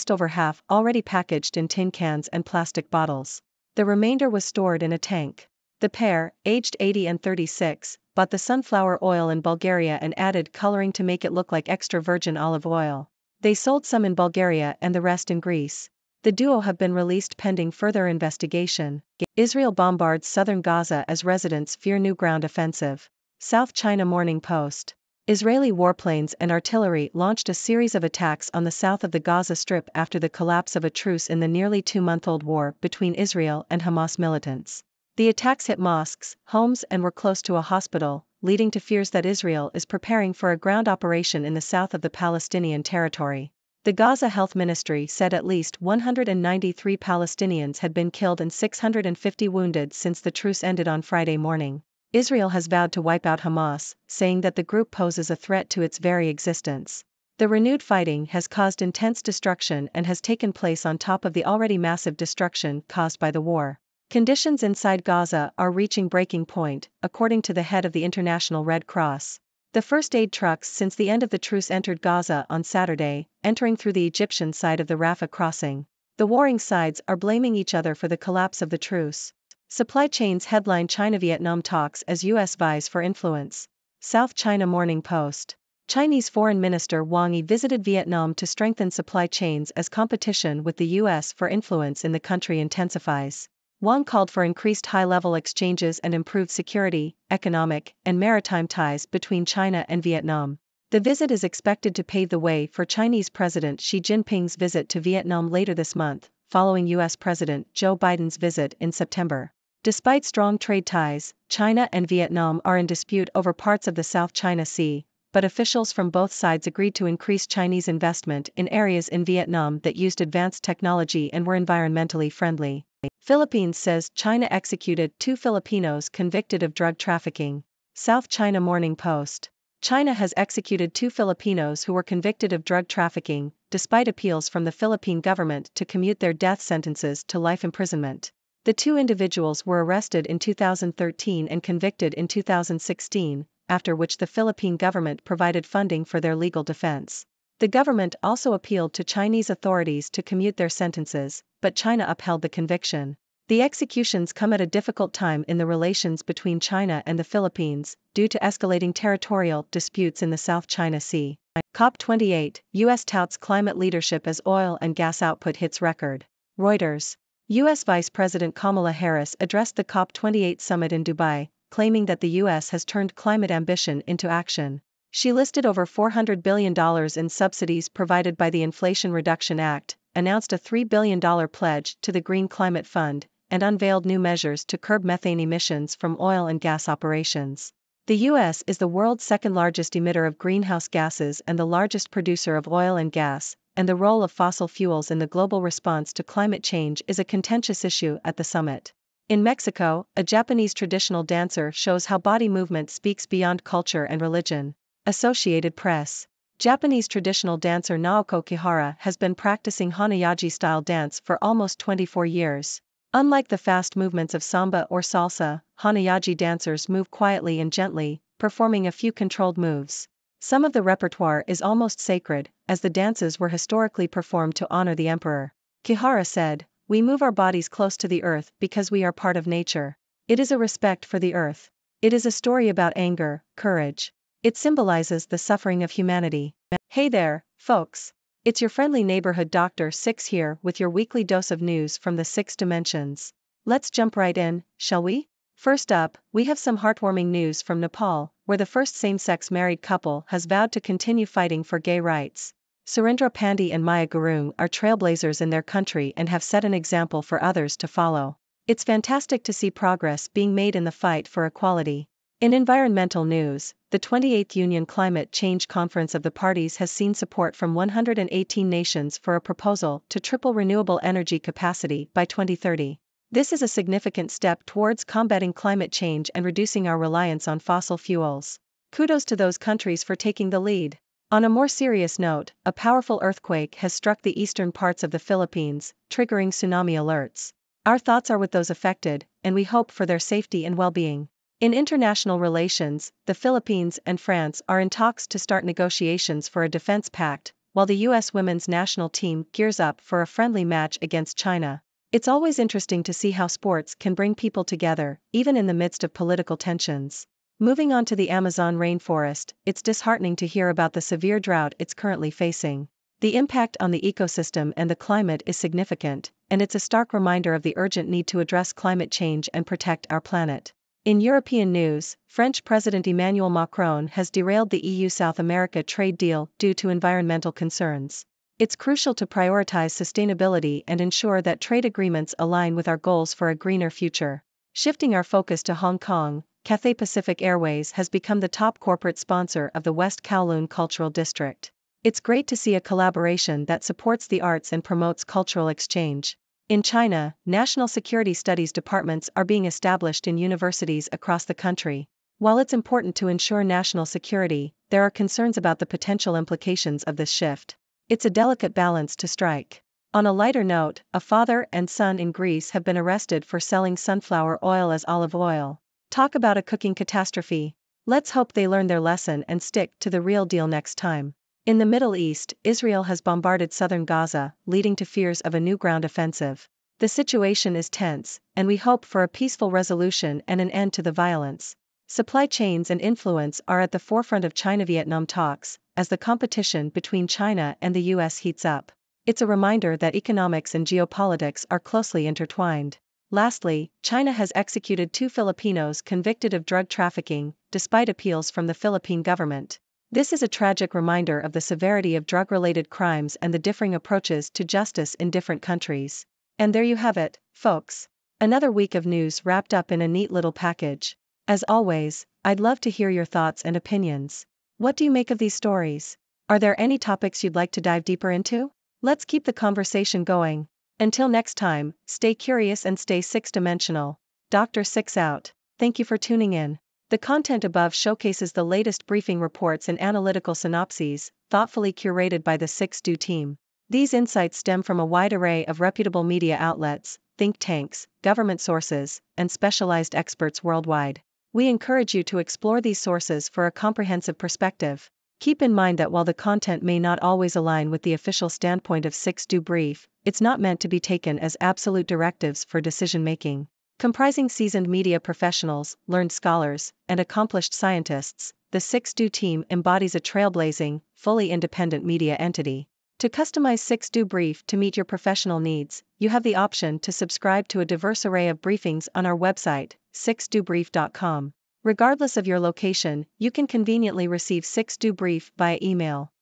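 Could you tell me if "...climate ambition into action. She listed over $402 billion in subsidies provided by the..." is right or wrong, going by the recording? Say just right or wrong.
wrong.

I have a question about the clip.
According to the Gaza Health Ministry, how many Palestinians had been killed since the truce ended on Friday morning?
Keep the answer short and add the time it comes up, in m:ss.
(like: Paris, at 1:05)
193, at 0:45.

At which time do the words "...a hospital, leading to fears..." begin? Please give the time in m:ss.
0:37.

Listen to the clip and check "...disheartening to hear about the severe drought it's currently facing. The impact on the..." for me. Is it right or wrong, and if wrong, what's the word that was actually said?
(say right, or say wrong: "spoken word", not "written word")
right.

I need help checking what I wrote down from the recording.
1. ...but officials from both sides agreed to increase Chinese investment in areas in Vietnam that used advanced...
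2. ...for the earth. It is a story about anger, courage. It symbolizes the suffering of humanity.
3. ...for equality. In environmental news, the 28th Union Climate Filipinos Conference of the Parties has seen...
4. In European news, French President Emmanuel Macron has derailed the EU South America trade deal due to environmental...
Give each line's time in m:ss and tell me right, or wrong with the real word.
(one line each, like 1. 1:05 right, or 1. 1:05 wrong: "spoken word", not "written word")
1. 1:55 right
2. 3:51 right
3. 4:21 wrong: "Change", not "Filipinos"
4. 5:21 right.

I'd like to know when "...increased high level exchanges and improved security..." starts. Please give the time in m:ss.
1:34.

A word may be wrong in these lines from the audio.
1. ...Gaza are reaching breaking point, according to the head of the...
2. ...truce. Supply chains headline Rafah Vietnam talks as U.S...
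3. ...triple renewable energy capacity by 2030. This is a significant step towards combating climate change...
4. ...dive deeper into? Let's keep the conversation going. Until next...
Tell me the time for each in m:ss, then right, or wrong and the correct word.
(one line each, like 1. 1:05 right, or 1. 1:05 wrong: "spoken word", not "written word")
1. 1:05 right
2. 1:18 wrong: "China", not "Rafah"
3. 4:30 right
4. 6:57 right.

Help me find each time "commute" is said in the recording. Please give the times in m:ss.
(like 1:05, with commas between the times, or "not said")
2:15, 2:30.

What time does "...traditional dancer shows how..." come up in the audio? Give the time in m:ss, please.
3:20.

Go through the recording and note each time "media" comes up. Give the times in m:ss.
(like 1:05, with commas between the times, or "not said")
7:16, 7:34, 7:42.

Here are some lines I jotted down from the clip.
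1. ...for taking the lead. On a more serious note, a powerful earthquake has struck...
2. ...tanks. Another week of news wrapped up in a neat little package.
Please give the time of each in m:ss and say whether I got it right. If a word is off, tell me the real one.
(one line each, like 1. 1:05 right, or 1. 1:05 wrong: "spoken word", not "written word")
1. 4:40 right
2. 6:47 wrong: "folks", not "tanks".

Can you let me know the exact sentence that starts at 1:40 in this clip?
The visit is expected to pave the way for Chinese President Xi Jinping's visit to Vietnam later this month, following U.S.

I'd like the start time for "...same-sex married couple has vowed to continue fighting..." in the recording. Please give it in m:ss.
4:08.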